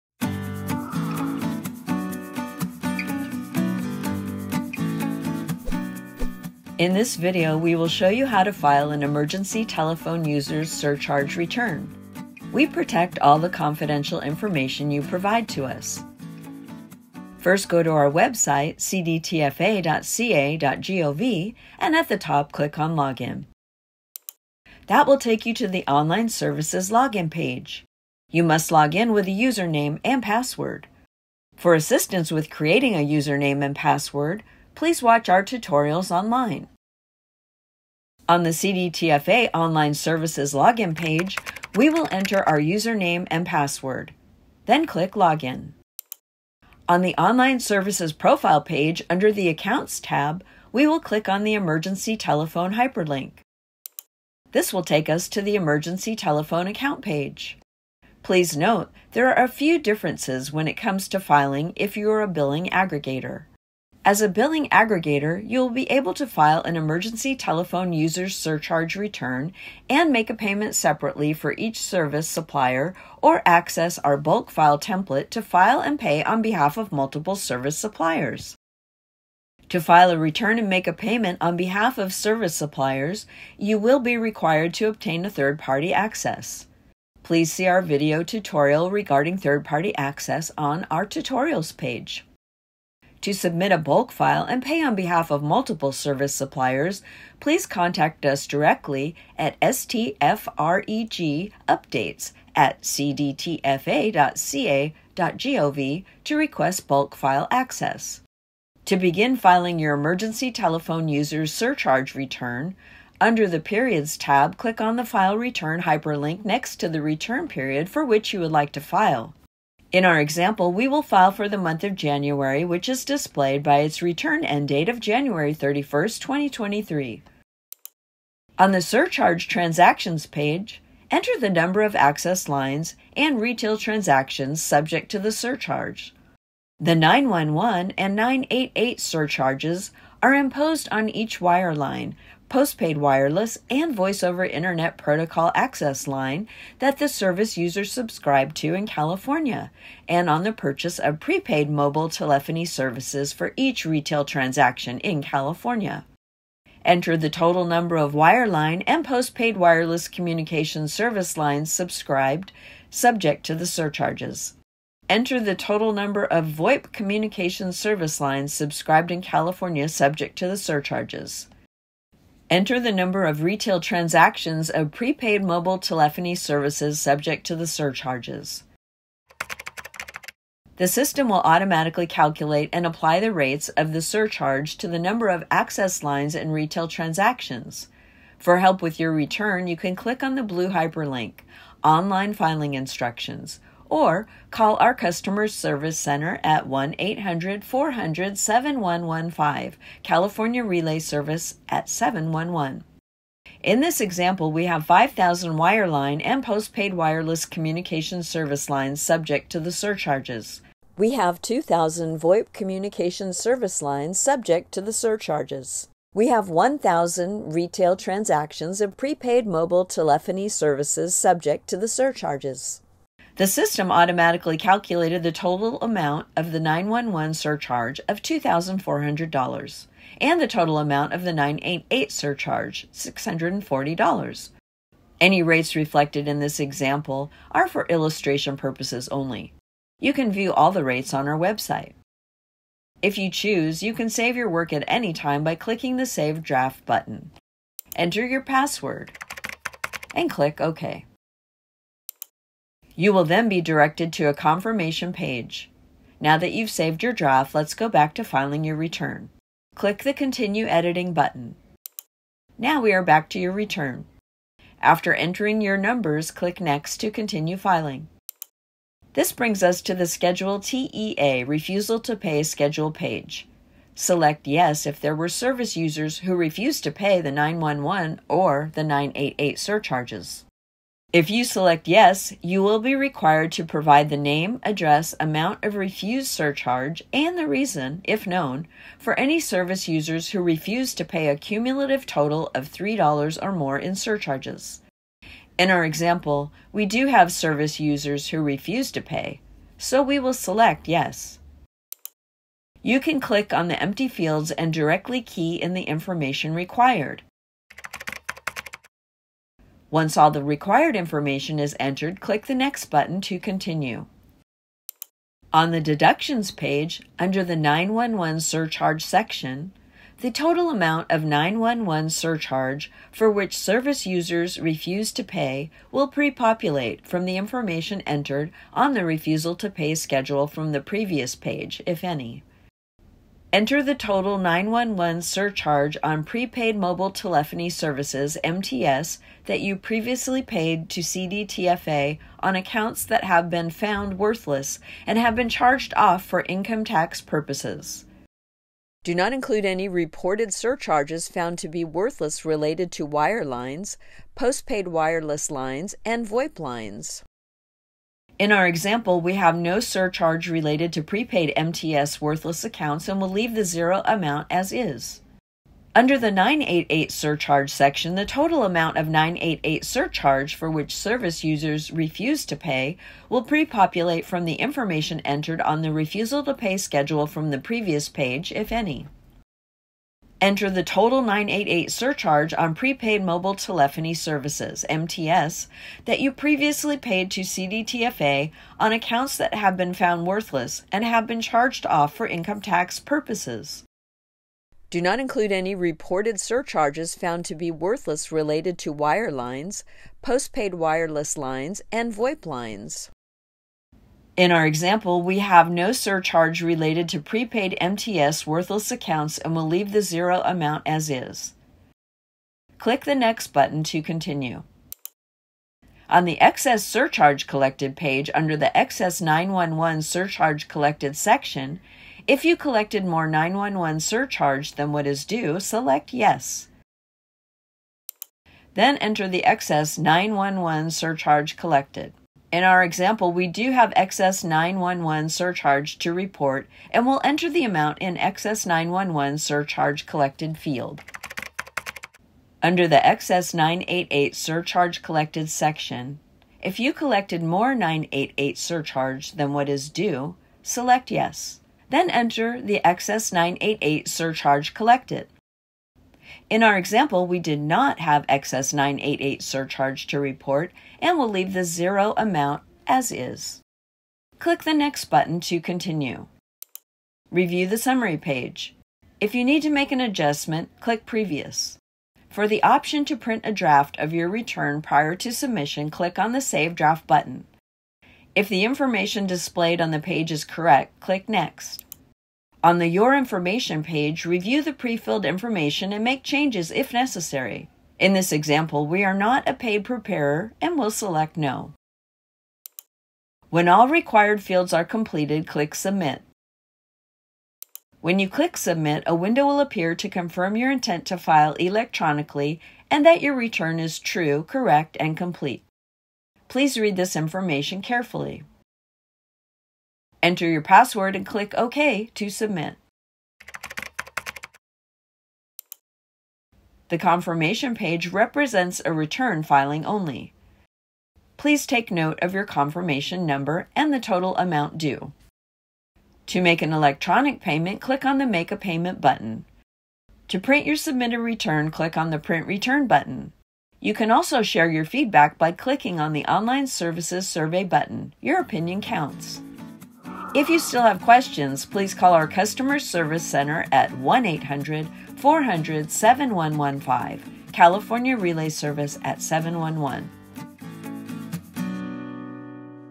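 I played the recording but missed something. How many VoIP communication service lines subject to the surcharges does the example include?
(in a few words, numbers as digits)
2,000.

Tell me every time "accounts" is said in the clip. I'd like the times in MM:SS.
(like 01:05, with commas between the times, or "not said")
00:49, 00:56, 05:42, 06:02, 06:28, 06:48.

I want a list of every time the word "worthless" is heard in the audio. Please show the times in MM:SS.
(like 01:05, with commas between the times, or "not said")
05:44, 05:51, 06:02, 06:30, 06:37, 06:48.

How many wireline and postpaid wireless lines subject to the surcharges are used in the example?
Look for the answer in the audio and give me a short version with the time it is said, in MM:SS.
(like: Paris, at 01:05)
5,000, at 03:24.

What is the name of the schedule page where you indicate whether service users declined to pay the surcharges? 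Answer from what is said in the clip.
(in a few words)
Schedule TEA.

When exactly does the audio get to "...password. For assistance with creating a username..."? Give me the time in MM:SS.
00:30.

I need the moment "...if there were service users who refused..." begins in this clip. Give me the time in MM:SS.
04:34.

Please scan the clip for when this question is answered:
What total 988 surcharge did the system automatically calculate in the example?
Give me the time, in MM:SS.
03:52.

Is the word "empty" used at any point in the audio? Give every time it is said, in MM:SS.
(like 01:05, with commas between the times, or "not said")
05:03.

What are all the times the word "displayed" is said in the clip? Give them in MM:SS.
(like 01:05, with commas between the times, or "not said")
02:03, 07:59.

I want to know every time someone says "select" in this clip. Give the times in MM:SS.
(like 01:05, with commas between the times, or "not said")
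04:33, 04:41, 05:00, 07:05, 07:30, 08:10.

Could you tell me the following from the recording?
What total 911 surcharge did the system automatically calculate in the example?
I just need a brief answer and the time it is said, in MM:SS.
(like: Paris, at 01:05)
$2,400, at 03:48.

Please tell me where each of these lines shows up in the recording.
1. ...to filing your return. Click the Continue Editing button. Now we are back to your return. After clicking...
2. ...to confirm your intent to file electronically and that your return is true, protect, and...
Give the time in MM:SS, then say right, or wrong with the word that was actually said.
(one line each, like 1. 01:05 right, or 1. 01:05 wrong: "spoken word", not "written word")
1. 04:18 wrong: "entering", not "clicking"
2. 08:19 wrong: "correct", not "protect".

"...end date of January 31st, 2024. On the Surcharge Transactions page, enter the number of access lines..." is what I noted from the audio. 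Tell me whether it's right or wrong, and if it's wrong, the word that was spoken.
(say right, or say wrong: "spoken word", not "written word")
wrong: "2023", not "2024".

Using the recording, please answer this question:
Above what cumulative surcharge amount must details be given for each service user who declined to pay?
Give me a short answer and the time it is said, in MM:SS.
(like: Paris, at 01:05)
$3, at 04:52.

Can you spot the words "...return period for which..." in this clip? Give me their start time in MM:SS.
01:57.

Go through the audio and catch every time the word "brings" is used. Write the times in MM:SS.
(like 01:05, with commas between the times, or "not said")
04:29.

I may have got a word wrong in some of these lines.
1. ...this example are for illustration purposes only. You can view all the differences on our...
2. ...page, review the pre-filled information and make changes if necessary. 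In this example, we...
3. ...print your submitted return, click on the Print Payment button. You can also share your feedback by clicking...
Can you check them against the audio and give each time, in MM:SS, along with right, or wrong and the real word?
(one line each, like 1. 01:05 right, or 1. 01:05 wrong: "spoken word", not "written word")
1. 03:56 wrong: "rates", not "differences"
2. 08:03 right
3. 08:50 wrong: "Return", not "Payment".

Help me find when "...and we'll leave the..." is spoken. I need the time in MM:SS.
07:40.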